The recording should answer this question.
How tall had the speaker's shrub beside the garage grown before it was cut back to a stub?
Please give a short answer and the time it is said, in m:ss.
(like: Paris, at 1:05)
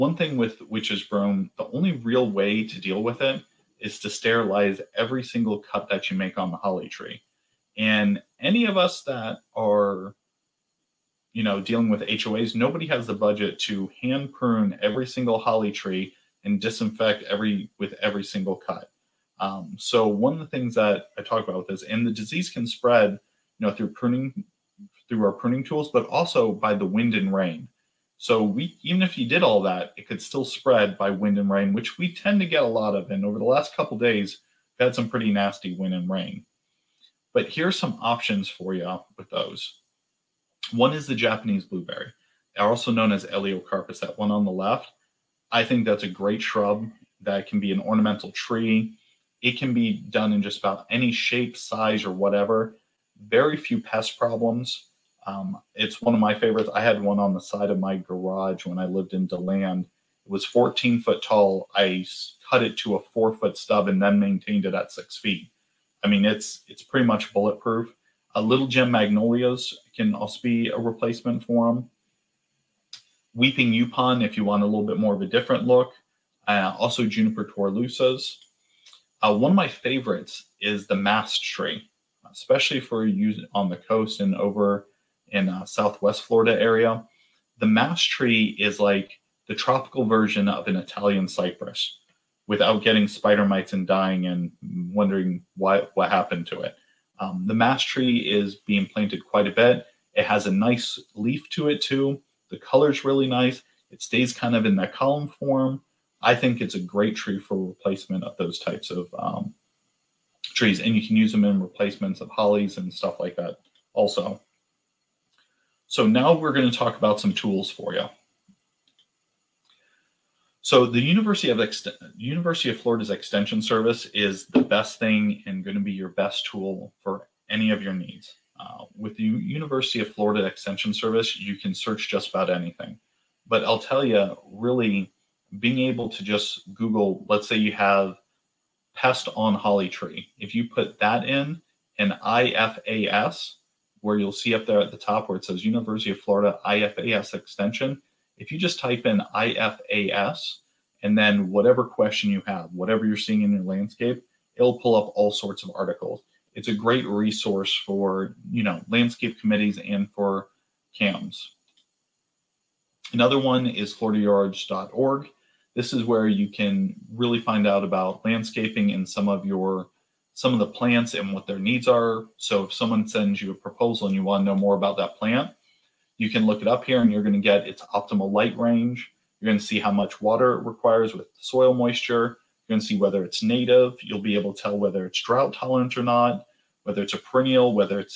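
14 feet, at 1:00.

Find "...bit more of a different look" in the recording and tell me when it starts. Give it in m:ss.
1:14.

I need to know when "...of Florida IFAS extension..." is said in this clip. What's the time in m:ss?
2:26.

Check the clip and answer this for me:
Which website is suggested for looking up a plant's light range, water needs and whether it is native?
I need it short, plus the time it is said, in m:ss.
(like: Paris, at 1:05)
floridayards.org, at 2:43.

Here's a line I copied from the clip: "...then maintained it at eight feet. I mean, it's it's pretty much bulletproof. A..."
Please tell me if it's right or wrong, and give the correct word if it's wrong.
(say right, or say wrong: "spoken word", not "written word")
wrong: "six", not "eight".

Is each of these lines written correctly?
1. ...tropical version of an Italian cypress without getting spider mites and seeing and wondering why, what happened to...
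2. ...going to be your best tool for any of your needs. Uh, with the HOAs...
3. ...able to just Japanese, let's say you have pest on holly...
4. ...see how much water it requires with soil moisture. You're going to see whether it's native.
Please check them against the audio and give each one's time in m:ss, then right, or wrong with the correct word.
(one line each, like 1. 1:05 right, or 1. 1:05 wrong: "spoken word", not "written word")
1. 1:29 wrong: "dying", not "seeing"
2. 2:05 wrong: "University", not "HOAs"
3. 2:15 wrong: "Google", not "Japanese"
4. 2:59 right.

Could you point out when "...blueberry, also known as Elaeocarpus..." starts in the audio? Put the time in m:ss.
0:41.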